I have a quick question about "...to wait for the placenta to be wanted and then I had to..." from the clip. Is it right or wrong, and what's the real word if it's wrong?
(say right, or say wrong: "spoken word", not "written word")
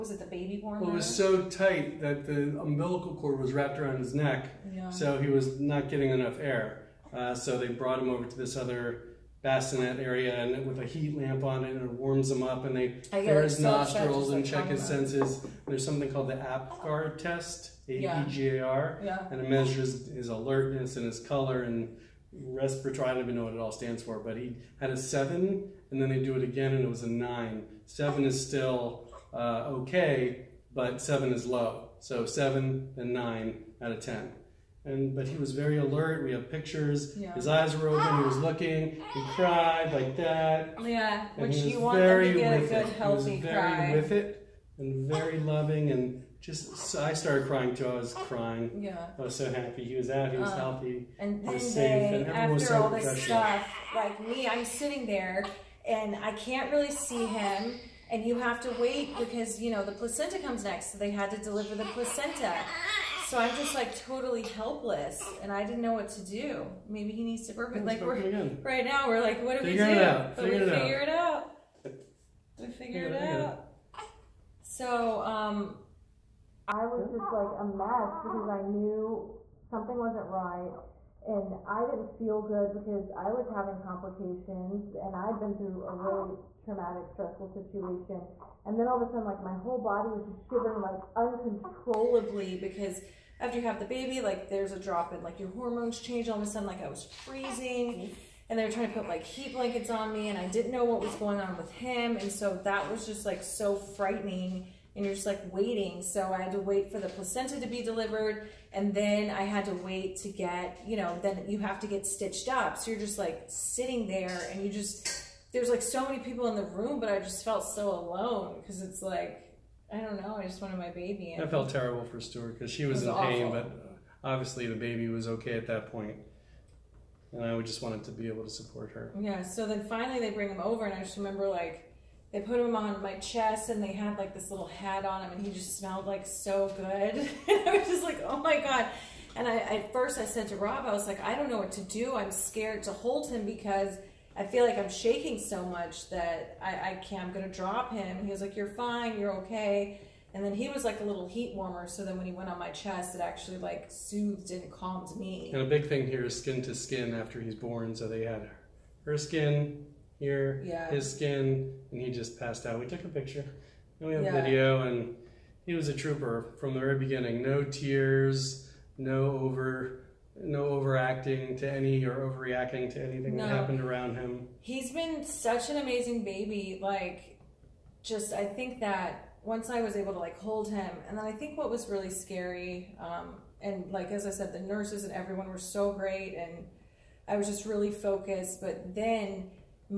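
wrong: "delivered", not "wanted".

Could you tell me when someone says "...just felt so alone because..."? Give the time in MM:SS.
01:57.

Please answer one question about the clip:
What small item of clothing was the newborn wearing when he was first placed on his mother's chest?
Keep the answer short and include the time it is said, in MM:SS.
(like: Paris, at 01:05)
little hat, at 02:14.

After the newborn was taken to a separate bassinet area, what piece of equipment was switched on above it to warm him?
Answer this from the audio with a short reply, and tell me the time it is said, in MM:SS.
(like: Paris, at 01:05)
heat lamp, at 00:10.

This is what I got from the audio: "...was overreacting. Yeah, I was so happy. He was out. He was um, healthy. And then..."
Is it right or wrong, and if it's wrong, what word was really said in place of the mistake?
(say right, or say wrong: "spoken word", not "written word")
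wrong: "crying", not "overreacting".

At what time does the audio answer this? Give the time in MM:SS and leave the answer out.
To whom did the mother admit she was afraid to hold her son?
02:20.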